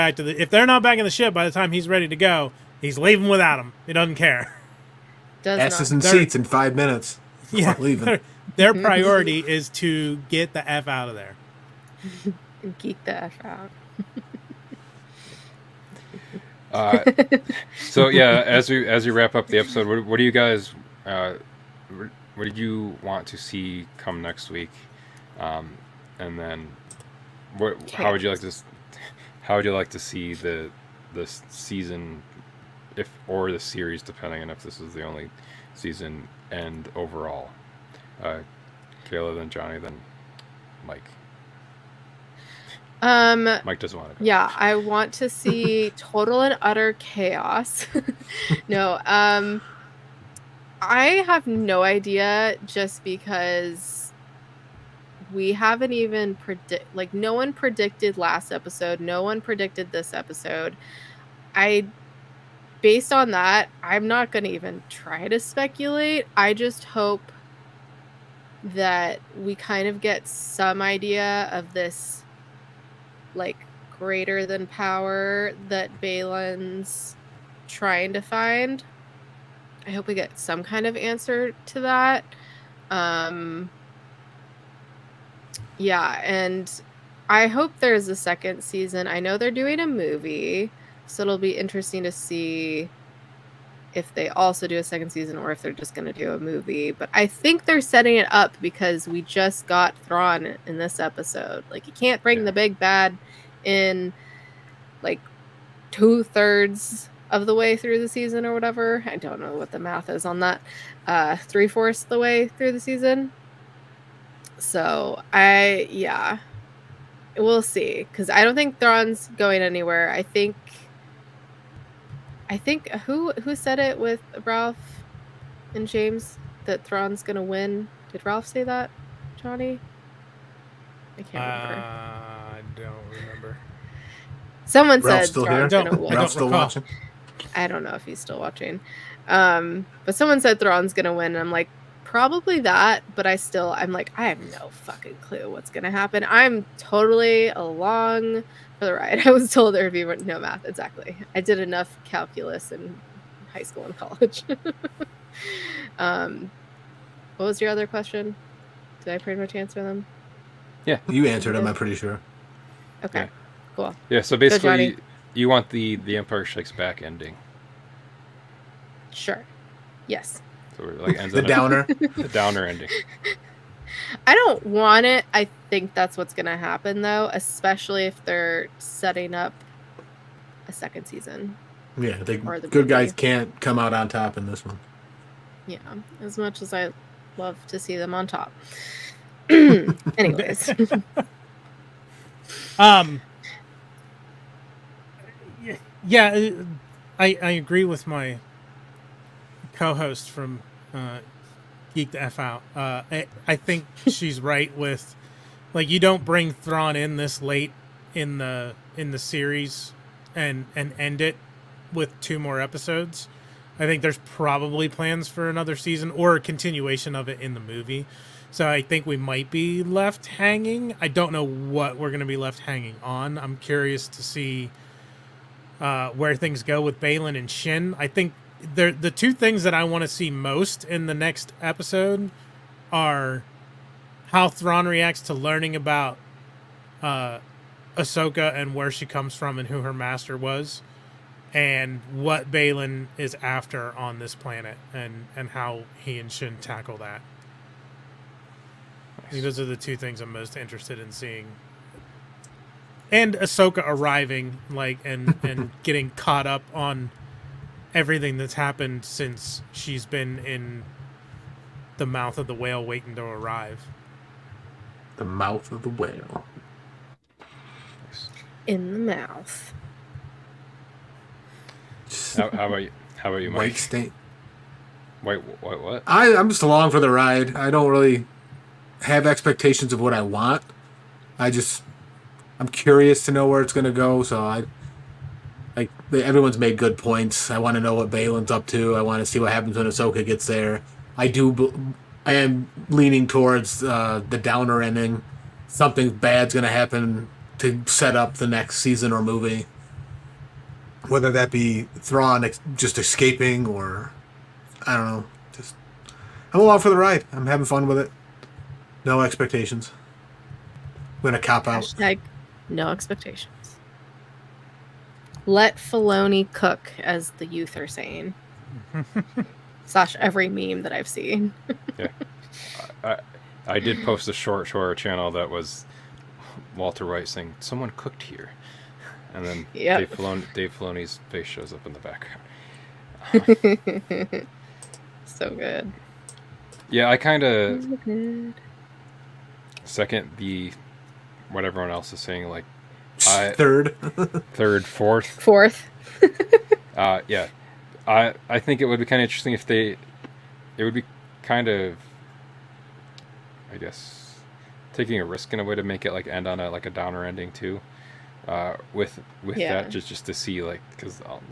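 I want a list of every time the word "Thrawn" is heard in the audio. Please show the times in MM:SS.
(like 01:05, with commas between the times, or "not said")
01:39, 01:58, 02:06, 02:15, 02:20, 03:26, 03:54, 05:01.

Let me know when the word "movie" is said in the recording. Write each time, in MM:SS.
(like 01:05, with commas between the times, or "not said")
01:29, 01:36, 03:02, 03:37, 04:59.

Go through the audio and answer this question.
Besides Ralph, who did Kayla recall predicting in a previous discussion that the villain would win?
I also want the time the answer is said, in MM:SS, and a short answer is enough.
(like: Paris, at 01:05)
James, at 02:04.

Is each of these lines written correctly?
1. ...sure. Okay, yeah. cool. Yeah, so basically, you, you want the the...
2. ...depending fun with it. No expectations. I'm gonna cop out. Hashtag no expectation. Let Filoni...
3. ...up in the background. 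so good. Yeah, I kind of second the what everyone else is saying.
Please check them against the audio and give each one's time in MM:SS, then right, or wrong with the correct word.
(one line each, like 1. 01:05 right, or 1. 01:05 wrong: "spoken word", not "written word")
1. 02:41 right
2. 05:07 wrong: "having", not "depending"
3. 05:31 right.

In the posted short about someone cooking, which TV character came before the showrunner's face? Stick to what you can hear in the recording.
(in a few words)
Walter White.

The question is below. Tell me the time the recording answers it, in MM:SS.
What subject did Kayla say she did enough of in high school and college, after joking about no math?
02:32.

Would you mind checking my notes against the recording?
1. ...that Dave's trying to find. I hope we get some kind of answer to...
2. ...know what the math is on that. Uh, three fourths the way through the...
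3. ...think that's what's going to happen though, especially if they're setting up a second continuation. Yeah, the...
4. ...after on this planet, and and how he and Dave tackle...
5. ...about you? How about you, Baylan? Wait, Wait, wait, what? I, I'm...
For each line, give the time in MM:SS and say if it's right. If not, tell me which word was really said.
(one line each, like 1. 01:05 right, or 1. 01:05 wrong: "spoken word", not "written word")
1. 01:15 wrong: "Baylan", not "Dave"
2. 01:49 right
3. 02:55 wrong: "season", not "continuation"
4. 04:03 wrong: "Shin", not "Dave"
5. 04:32 wrong: "Mike", not "Baylan".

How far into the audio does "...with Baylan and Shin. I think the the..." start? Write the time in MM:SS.
03:46.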